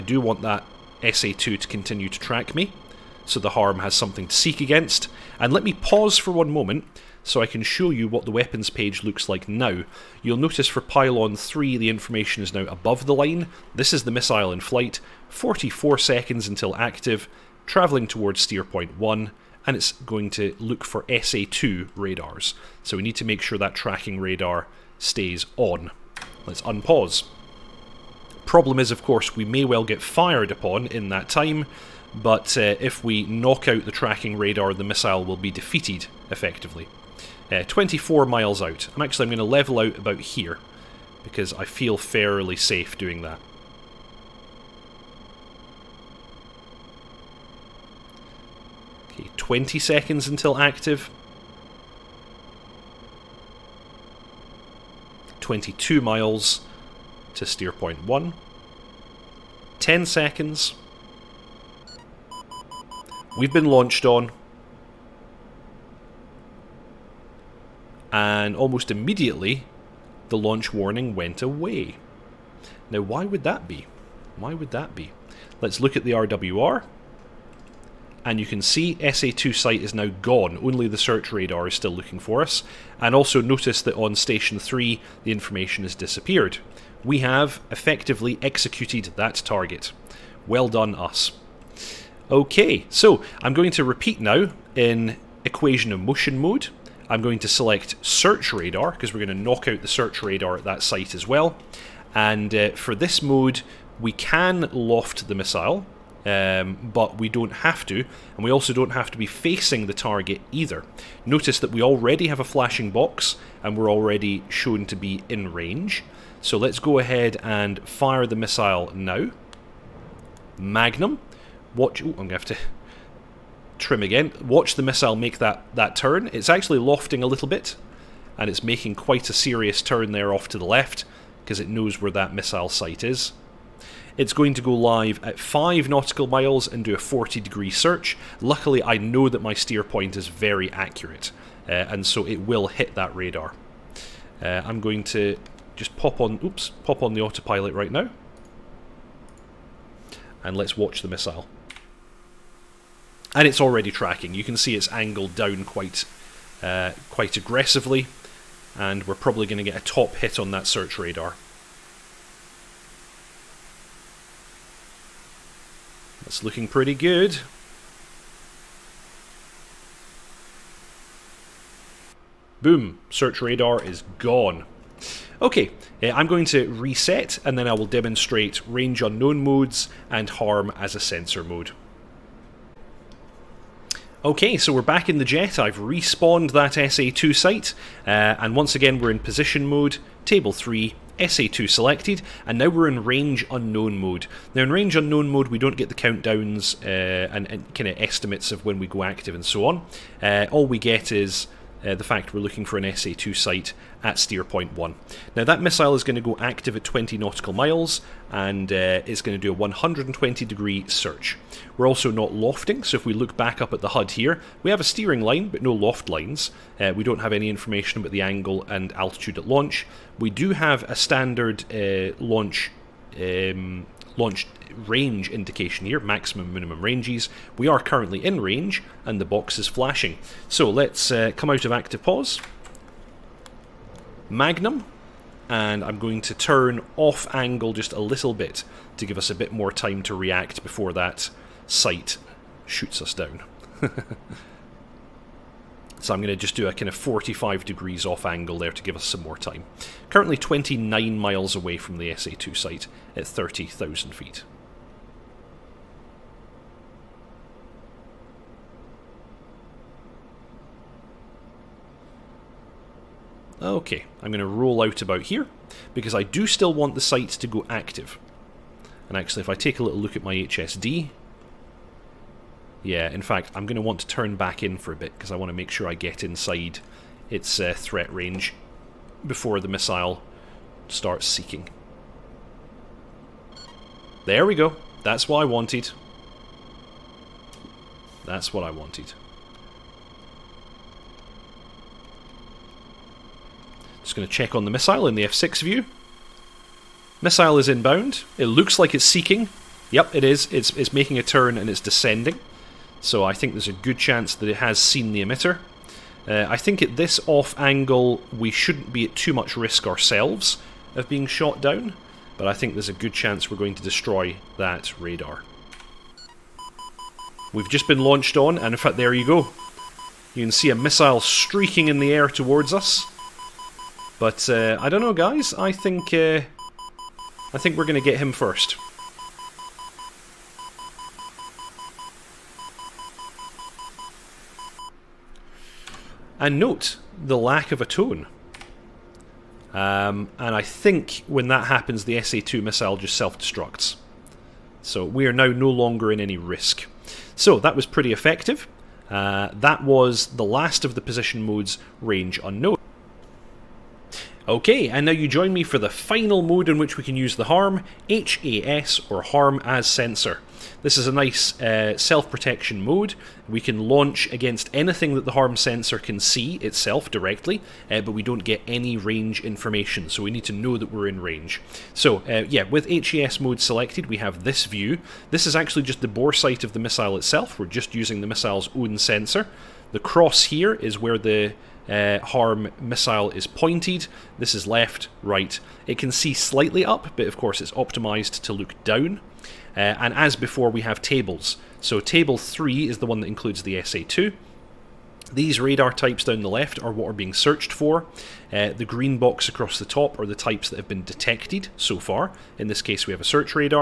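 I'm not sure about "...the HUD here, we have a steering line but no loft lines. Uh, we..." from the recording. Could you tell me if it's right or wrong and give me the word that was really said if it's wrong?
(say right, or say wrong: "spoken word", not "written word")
right.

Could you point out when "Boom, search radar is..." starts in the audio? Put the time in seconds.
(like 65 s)
172 s.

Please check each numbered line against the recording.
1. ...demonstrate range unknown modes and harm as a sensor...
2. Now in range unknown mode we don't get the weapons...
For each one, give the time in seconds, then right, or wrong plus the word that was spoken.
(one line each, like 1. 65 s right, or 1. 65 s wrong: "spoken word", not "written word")
1. 177 s right
2. 194 s wrong: "countdowns", not "weapons".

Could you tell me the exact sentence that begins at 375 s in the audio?
This is actually just the bore sight of the missile itself.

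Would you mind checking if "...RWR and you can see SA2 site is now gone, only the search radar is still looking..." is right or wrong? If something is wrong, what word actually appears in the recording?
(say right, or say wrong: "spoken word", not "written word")
right.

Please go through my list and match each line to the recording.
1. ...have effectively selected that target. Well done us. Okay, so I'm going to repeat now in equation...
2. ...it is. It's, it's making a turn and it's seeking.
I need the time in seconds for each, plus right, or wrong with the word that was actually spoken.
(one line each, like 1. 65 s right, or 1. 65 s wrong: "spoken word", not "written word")
1. 87 s wrong: "executed", not "selected"
2. 300 s wrong: "descending", not "seeking".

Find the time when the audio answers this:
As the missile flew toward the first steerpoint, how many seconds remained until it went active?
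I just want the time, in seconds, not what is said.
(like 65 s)
15 s.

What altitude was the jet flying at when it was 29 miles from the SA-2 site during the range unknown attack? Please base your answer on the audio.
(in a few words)
30,000 feet.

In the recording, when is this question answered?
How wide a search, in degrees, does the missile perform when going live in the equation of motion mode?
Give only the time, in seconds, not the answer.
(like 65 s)
136 s.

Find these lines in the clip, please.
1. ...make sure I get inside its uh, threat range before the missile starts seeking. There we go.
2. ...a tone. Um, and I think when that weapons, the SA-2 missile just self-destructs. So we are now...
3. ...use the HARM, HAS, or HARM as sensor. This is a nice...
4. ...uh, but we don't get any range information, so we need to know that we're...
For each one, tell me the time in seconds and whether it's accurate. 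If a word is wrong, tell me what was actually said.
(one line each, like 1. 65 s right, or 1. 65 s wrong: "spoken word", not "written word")
1. 275 s right
2. 337 s wrong: "happens", not "weapons"
3. 357 s right
4. 367 s right.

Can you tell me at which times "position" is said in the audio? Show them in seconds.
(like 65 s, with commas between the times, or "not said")
189 s, 351 s.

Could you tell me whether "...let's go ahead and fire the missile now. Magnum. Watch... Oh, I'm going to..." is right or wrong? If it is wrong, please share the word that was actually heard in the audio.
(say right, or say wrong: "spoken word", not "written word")
right.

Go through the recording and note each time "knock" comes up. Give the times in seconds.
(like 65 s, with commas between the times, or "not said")
33 s, 99 s.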